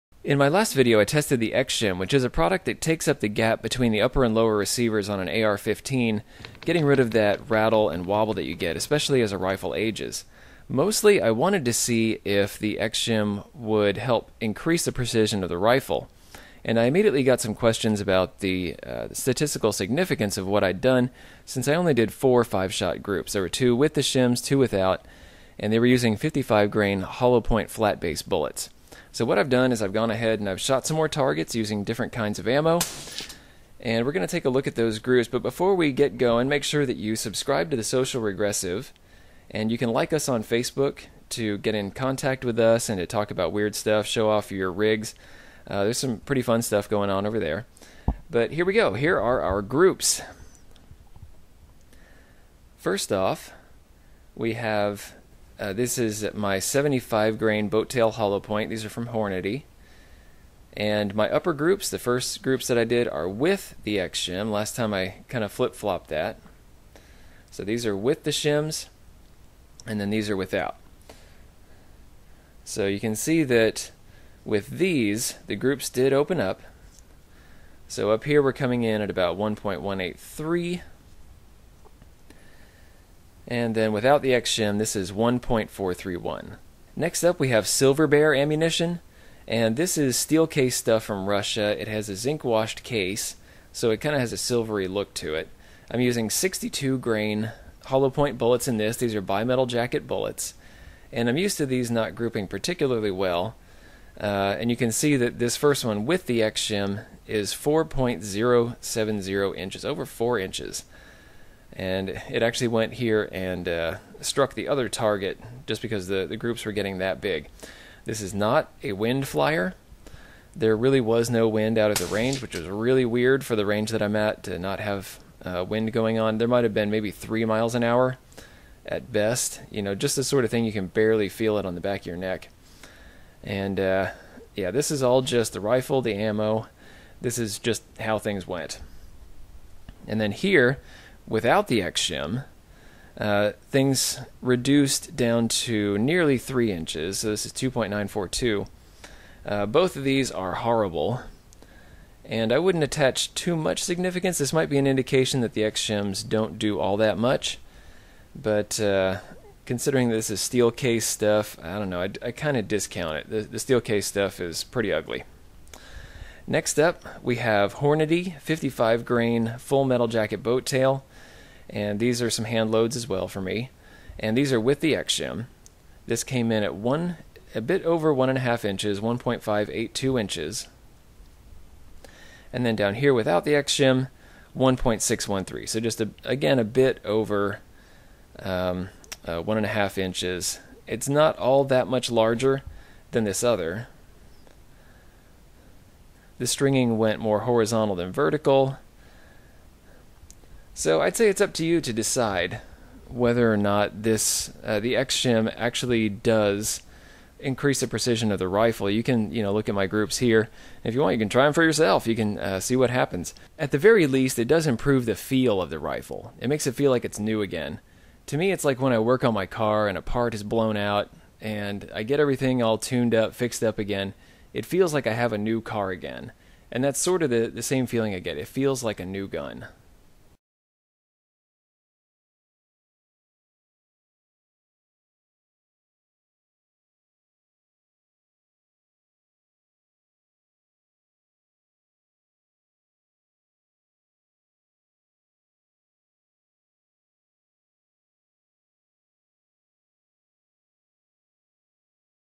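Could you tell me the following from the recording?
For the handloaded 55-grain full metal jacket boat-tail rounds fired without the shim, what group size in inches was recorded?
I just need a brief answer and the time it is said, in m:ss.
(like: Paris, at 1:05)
1.613, at 3:04.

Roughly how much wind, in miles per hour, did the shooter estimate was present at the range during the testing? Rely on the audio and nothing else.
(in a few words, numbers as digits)
3.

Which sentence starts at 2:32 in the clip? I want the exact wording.
And I wouldn't attach too much significance.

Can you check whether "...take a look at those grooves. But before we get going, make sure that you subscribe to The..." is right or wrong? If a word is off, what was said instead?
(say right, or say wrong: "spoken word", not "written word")
right.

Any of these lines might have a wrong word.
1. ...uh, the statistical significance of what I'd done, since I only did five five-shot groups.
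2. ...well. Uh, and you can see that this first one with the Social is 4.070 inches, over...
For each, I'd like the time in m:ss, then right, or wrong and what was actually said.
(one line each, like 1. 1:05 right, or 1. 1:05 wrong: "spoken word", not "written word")
1. 0:18 wrong: "four", not "five"
2. 1:43 wrong: "XSHIM", not "Social".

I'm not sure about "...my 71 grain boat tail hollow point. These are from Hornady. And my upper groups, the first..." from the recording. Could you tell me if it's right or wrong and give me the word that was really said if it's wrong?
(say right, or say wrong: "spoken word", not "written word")
wrong: "75", not "71".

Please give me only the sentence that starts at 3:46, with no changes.
And that's sort of the, the same feeling I get.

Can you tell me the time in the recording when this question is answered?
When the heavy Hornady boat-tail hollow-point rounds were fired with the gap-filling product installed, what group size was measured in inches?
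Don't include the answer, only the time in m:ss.
1:19.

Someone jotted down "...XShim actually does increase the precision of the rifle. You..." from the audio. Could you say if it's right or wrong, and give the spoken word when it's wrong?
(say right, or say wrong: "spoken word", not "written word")
right.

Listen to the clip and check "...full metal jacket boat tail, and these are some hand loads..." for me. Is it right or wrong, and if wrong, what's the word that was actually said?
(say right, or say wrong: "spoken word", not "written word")
right.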